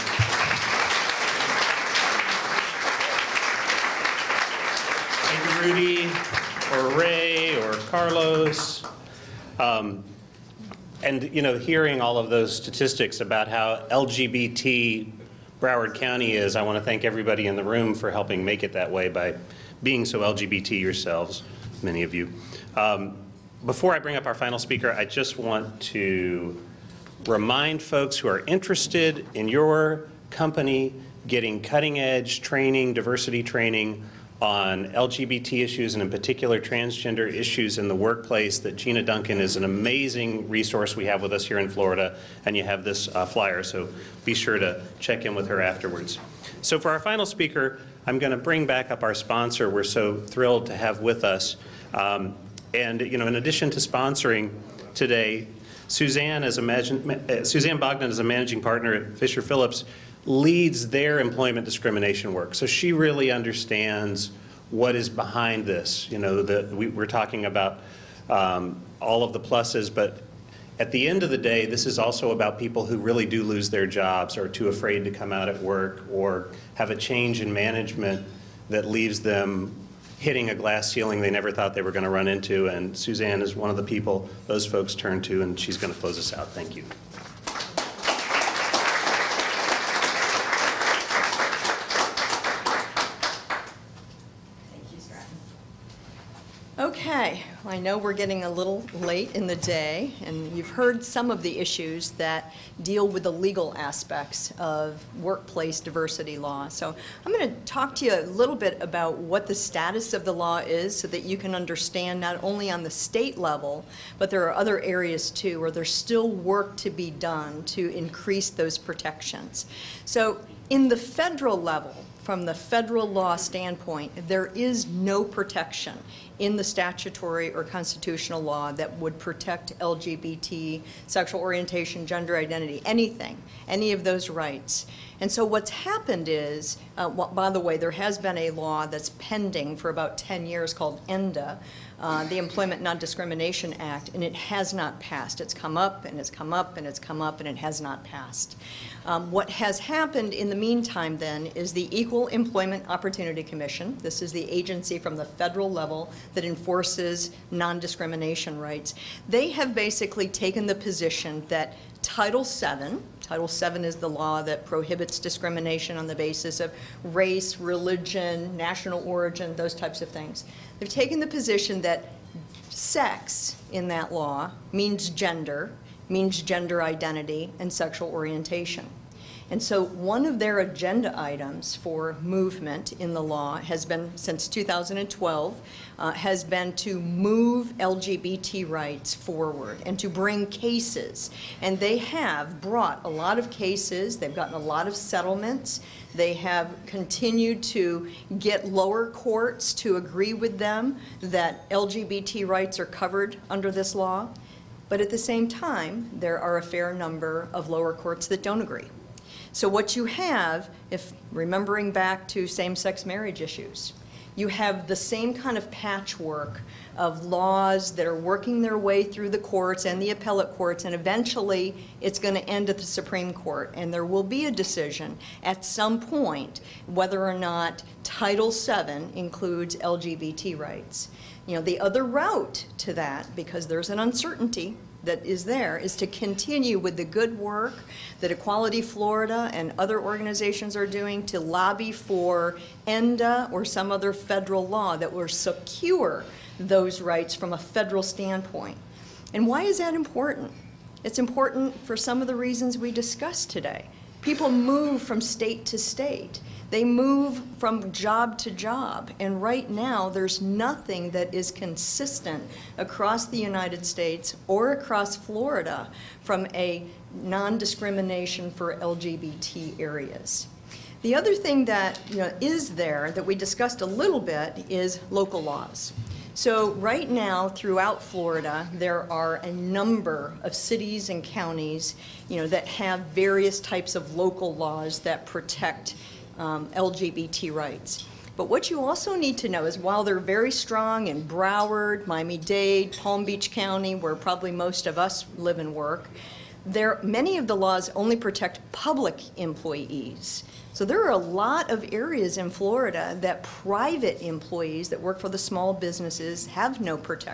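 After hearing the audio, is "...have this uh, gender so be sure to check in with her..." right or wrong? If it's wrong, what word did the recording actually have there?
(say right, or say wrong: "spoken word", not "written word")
wrong: "flyer", not "gender".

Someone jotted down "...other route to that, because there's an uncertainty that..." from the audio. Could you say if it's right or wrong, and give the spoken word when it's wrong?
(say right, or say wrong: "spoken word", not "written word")
right.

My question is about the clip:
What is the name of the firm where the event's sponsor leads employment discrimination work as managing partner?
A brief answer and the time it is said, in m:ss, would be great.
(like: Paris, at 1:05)
Fisher Phillips, at 0:59.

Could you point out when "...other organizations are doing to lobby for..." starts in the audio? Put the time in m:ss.
3:59.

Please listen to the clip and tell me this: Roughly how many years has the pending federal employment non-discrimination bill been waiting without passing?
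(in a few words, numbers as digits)
10 years.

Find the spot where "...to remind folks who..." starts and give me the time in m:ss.
0:25.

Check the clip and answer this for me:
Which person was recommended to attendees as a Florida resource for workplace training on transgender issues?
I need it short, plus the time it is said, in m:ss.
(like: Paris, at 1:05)
Gina Duncan, at 0:38.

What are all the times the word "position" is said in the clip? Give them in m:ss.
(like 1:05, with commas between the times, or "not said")
2:40, 2:51.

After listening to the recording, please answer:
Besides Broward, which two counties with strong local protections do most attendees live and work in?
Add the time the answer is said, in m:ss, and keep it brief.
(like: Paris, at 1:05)
Miami-Dade, Palm Beach, at 4:52.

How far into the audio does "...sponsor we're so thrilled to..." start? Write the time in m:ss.
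0:49.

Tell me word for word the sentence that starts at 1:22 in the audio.
And Suzanne is one of the people those folks turn to, and she's going to close us out.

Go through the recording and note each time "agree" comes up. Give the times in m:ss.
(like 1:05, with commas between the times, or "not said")
3:19, 3:28.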